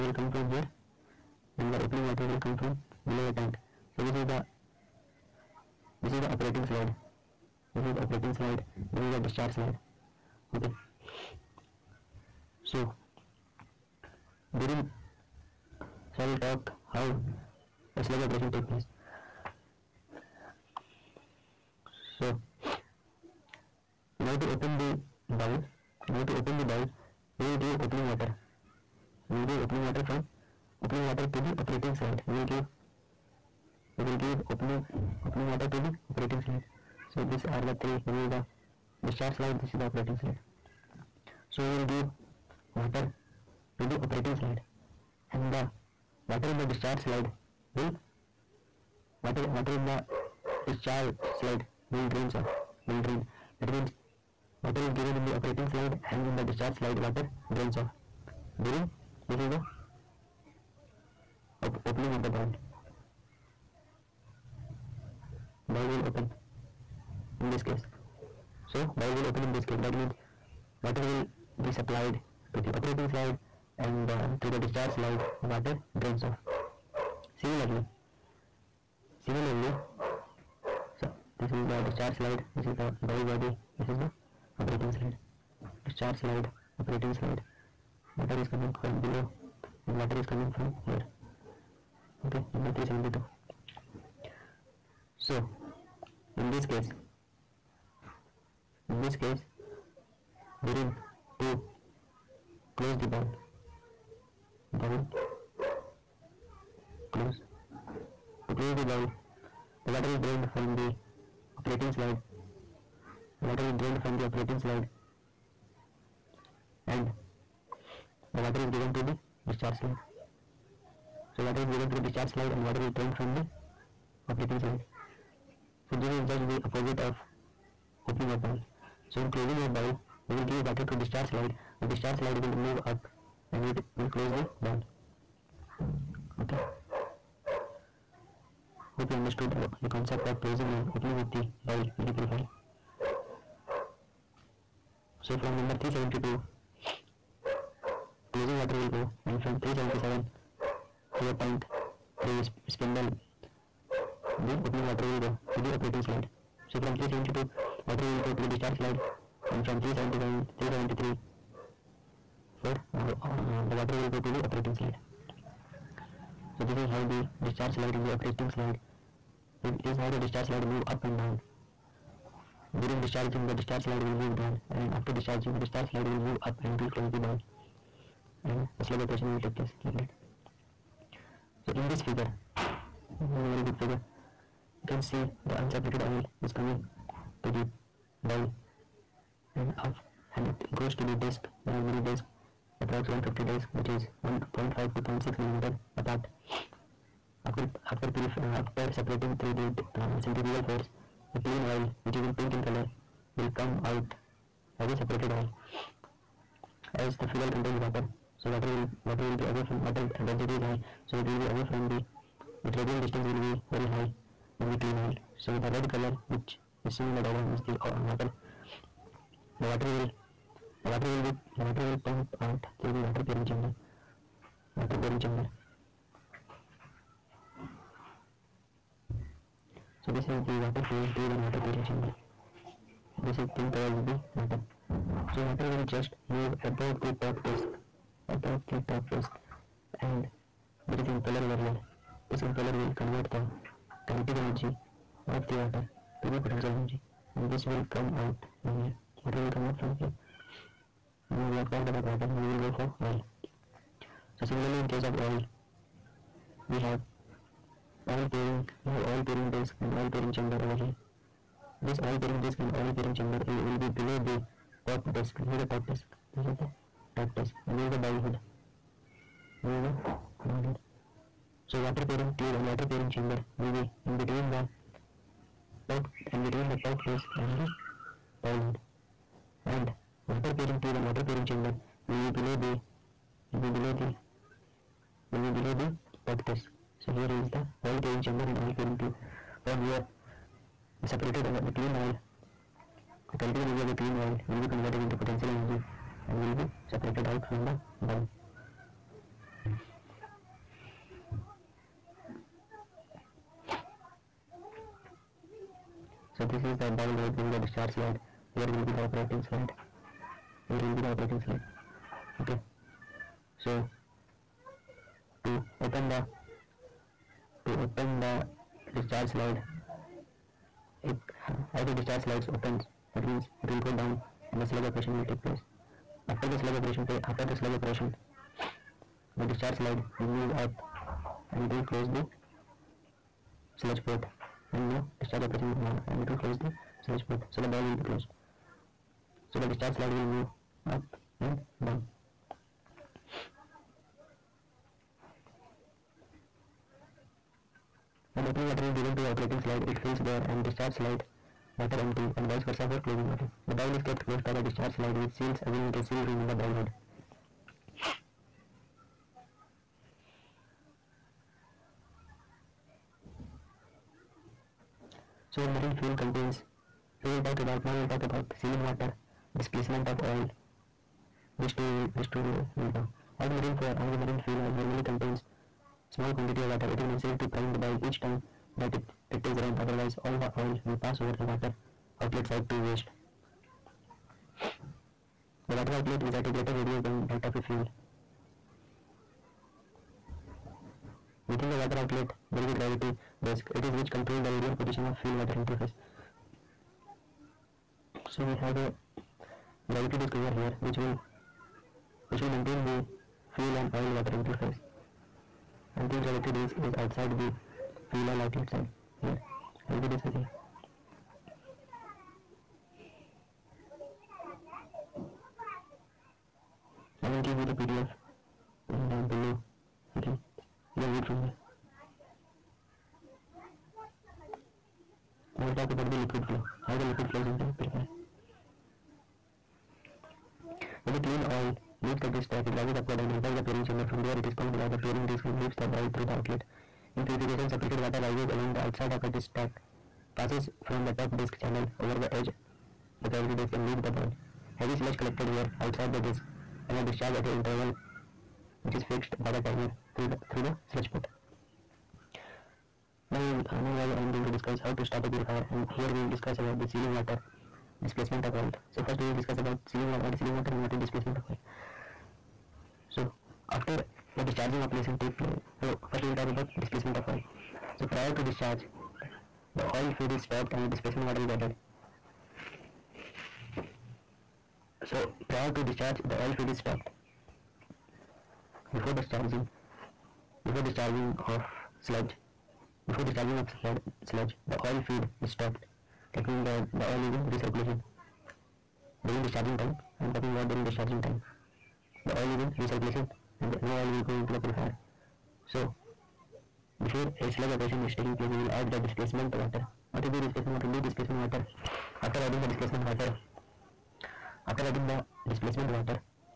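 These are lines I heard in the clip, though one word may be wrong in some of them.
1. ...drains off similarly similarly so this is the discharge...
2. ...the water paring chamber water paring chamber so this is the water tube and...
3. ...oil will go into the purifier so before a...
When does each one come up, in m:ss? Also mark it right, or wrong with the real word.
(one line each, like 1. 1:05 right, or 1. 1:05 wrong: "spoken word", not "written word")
1. 1:16 right
2. 3:42 right
3. 8:13 right.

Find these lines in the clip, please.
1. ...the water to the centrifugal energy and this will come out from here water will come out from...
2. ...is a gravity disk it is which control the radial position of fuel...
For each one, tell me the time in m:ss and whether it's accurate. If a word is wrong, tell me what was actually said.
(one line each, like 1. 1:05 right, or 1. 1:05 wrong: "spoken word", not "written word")
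1. 4:05 wrong: "potential", not "centrifugal"
2. 6:32 right.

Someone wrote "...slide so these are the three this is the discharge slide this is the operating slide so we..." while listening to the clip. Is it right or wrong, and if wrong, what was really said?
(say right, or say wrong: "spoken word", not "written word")
right.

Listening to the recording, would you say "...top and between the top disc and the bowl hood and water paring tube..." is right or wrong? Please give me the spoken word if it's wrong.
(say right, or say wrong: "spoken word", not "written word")
right.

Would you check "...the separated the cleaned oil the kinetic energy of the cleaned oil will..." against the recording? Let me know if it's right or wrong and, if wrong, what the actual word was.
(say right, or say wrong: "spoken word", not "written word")
right.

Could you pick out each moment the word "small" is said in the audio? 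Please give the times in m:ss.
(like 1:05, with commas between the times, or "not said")
6:16.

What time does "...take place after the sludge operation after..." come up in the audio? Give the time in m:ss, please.
5:25.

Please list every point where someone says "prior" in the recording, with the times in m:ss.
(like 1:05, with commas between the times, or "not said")
7:48, 7:55.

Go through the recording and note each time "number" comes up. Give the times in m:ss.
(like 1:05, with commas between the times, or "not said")
1:32, 2:25.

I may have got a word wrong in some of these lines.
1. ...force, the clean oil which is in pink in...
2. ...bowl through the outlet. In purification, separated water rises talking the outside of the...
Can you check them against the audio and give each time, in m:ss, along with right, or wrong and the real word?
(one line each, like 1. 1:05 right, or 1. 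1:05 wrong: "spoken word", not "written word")
1. 3:20 right
2. 7:15 wrong: "along", not "talking".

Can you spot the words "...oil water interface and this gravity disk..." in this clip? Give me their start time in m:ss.
6:44.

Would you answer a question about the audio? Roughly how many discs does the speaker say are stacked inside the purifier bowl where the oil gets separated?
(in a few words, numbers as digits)
150.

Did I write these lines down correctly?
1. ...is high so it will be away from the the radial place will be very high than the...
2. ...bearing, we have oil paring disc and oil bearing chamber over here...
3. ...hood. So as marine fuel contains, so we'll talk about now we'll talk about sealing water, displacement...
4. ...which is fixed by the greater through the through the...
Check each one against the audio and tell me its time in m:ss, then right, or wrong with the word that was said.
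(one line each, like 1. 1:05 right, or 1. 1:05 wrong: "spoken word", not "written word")
1. 3:30 wrong: "distance", not "place"
2. 4:18 wrong: "paring", not "bearing"
3. 5:56 right
4. 7:28 wrong: "timer", not "greater".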